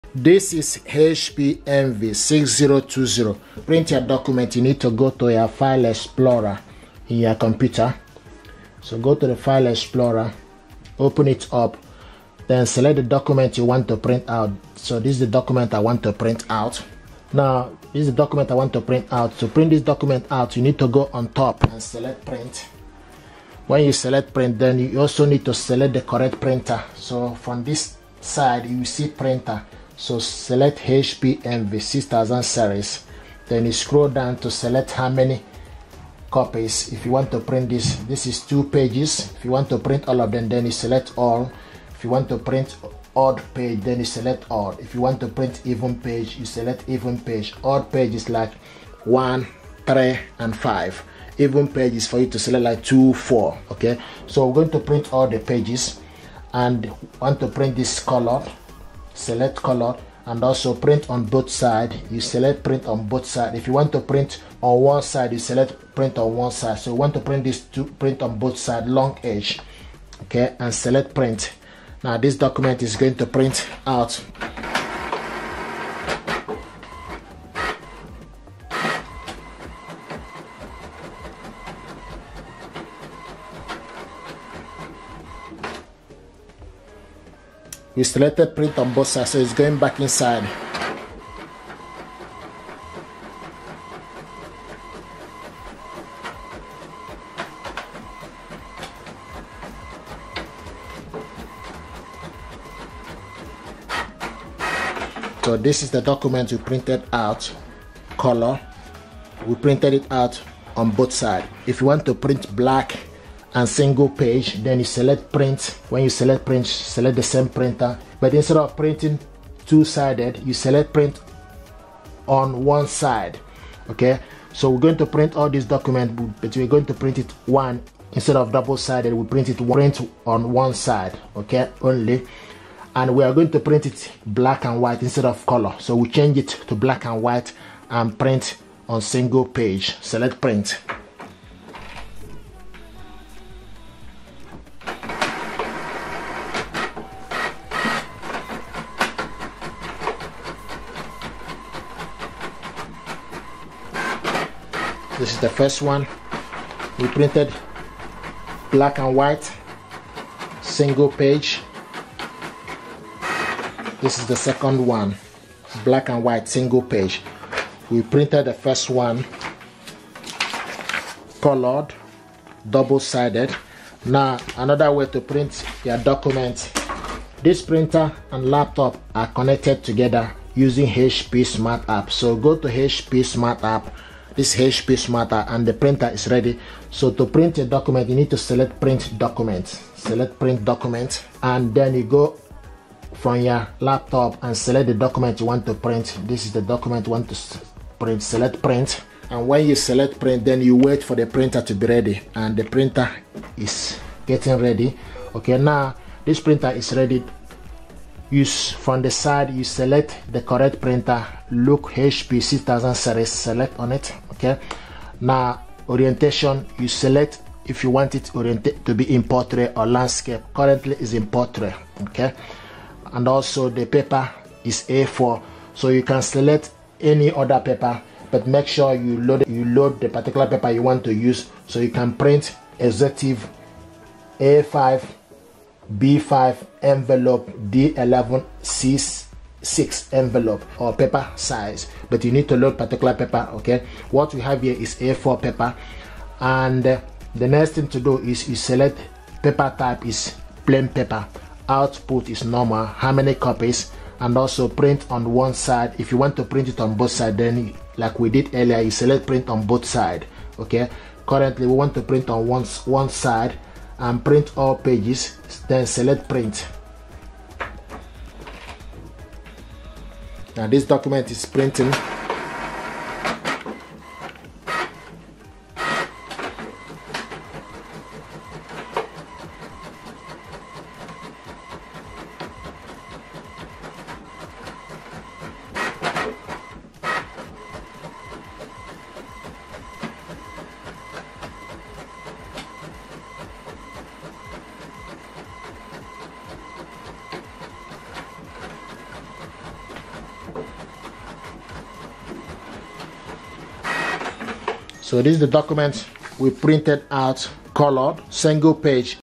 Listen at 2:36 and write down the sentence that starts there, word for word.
We printed black and white, single page.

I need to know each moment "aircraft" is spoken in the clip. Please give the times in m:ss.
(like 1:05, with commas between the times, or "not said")
not said.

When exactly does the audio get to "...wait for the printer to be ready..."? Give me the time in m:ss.
3:20.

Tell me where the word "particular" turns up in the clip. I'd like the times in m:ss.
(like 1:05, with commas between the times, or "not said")
3:50, 4:02.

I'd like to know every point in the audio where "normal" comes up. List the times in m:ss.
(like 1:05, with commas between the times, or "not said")
4:12.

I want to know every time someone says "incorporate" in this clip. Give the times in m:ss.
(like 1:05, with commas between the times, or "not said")
not said.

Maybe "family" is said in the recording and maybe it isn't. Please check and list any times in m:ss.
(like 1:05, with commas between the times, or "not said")
not said.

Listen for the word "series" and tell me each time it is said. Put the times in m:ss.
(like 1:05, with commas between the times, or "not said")
0:32, 3:32.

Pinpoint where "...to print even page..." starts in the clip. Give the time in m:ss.
0:45.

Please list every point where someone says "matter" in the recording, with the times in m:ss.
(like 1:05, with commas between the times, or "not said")
3:05.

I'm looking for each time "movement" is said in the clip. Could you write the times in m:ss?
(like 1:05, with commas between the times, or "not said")
not said.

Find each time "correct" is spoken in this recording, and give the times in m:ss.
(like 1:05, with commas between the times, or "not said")
0:26, 3:30.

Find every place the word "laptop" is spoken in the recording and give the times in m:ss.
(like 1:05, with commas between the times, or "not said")
2:58, 3:13.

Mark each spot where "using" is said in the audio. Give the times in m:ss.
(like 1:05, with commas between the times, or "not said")
3:00.